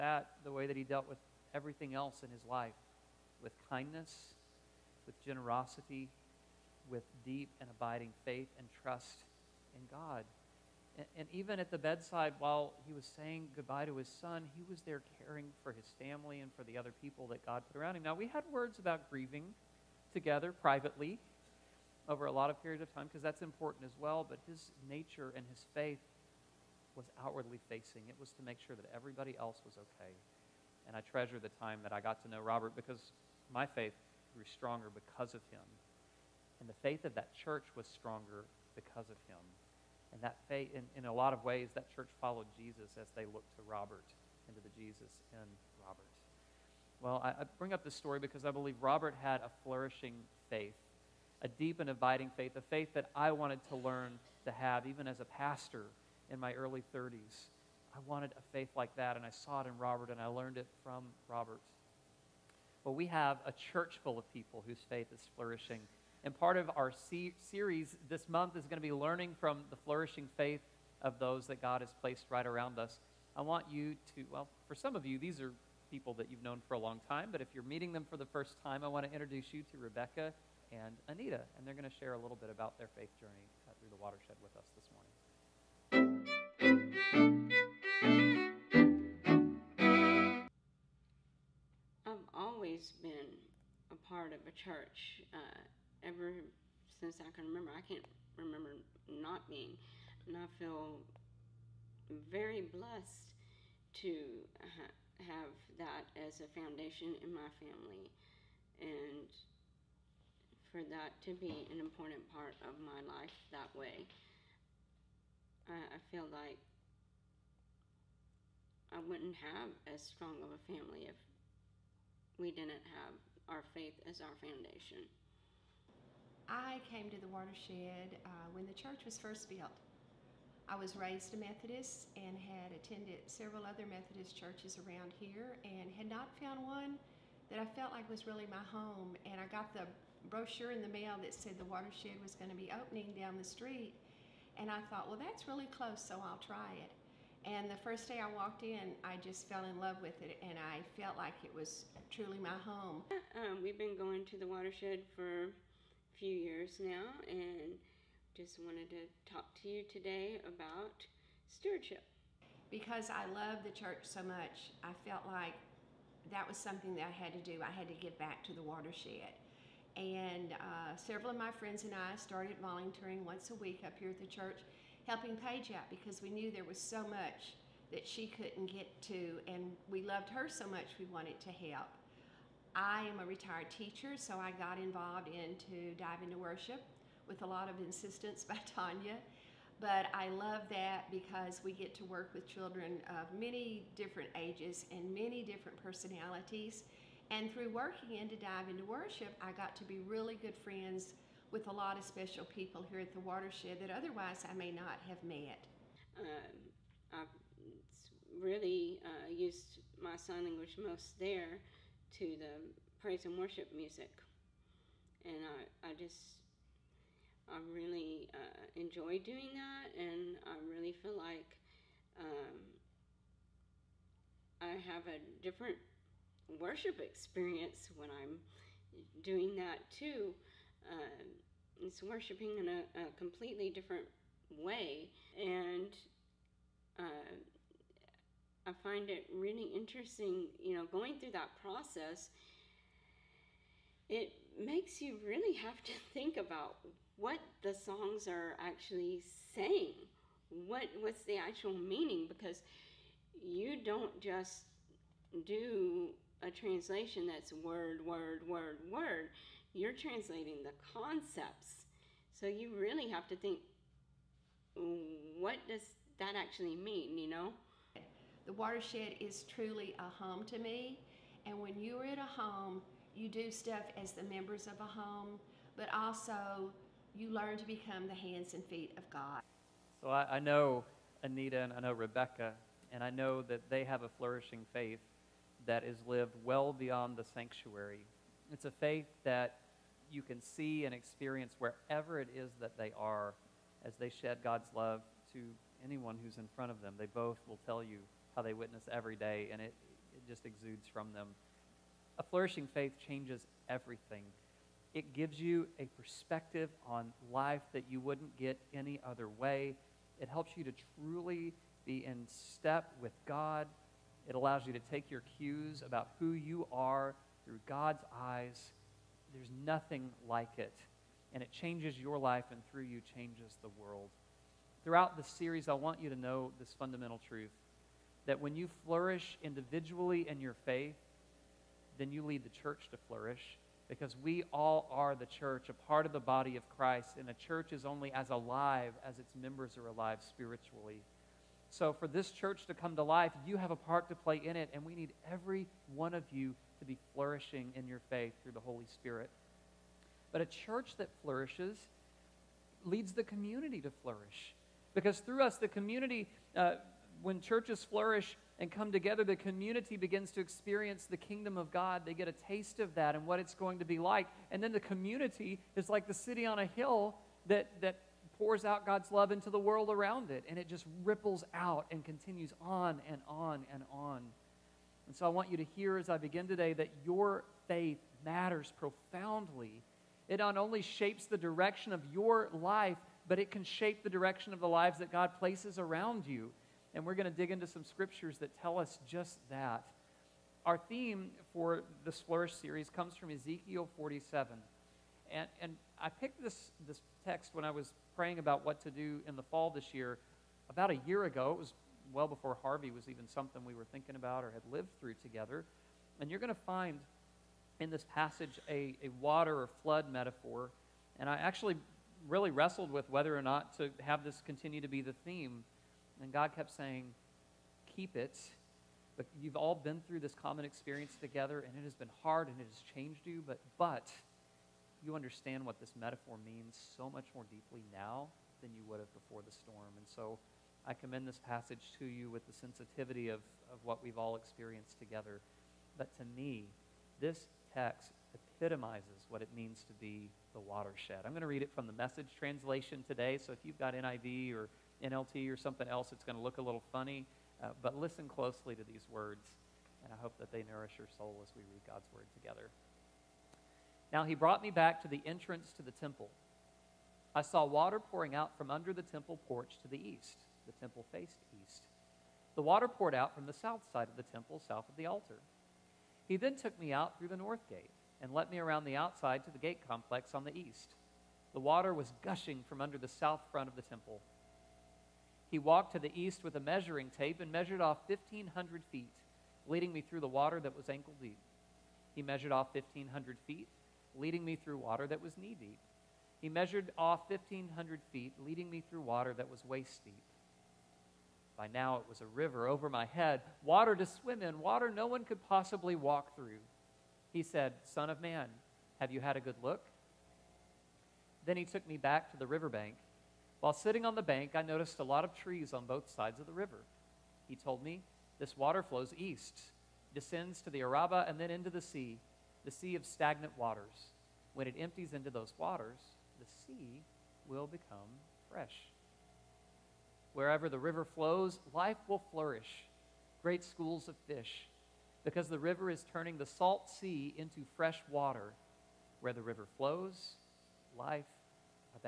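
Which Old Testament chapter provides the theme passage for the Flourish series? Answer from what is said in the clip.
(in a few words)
Ezekiel 47.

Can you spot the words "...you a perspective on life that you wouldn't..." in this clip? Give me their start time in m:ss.
5:05.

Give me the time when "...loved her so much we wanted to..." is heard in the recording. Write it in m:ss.
3:00.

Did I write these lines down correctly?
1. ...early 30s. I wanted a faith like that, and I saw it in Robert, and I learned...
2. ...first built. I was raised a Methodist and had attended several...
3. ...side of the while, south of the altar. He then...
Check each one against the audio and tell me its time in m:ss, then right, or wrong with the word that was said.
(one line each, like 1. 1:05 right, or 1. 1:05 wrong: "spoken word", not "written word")
1. 0:56 right
2. 2:09 right
3. 7:43 wrong: "temple", not "while".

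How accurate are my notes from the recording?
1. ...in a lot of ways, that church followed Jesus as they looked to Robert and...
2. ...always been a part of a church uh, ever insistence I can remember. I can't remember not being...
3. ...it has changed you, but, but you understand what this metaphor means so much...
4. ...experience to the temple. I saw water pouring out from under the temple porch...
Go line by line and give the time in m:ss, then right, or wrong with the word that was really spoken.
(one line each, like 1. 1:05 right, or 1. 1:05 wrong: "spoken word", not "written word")
1. 0:40 right
2. 1:32 wrong: "since", not "insistence"
3. 7:02 right
4. 7:35 wrong: "entrance", not "experience".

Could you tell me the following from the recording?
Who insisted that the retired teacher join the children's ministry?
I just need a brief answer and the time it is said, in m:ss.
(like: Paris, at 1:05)
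Tanya, at 3:08.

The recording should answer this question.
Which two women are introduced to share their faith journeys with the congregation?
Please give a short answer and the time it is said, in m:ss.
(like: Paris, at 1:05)
Rebecca and Anita, at 1:19.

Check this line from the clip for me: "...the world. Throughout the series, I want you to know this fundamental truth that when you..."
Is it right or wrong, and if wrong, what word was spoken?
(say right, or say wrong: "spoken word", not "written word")
right.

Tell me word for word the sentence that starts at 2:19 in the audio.
And I got the brochure in the mail that said the watershed was going to be opening down the street.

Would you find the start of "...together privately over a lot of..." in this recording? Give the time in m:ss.
0:20.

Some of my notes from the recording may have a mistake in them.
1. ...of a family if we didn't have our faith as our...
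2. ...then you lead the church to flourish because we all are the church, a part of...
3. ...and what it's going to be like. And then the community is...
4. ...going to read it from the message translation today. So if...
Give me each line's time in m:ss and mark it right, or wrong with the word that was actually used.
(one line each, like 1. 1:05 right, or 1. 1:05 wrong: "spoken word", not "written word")
1. 2:00 right
2. 5:31 right
3. 6:03 right
4. 7:21 right.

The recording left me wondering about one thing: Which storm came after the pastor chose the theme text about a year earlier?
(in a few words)
Harvey.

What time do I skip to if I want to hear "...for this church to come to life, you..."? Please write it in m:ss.
5:41.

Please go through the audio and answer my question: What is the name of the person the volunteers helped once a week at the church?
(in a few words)
Paige.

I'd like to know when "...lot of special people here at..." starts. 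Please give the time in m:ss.
3:21.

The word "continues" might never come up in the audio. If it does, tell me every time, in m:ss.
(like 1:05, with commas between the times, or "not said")
6:12, 6:54.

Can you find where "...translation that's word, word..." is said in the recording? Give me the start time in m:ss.
4:16.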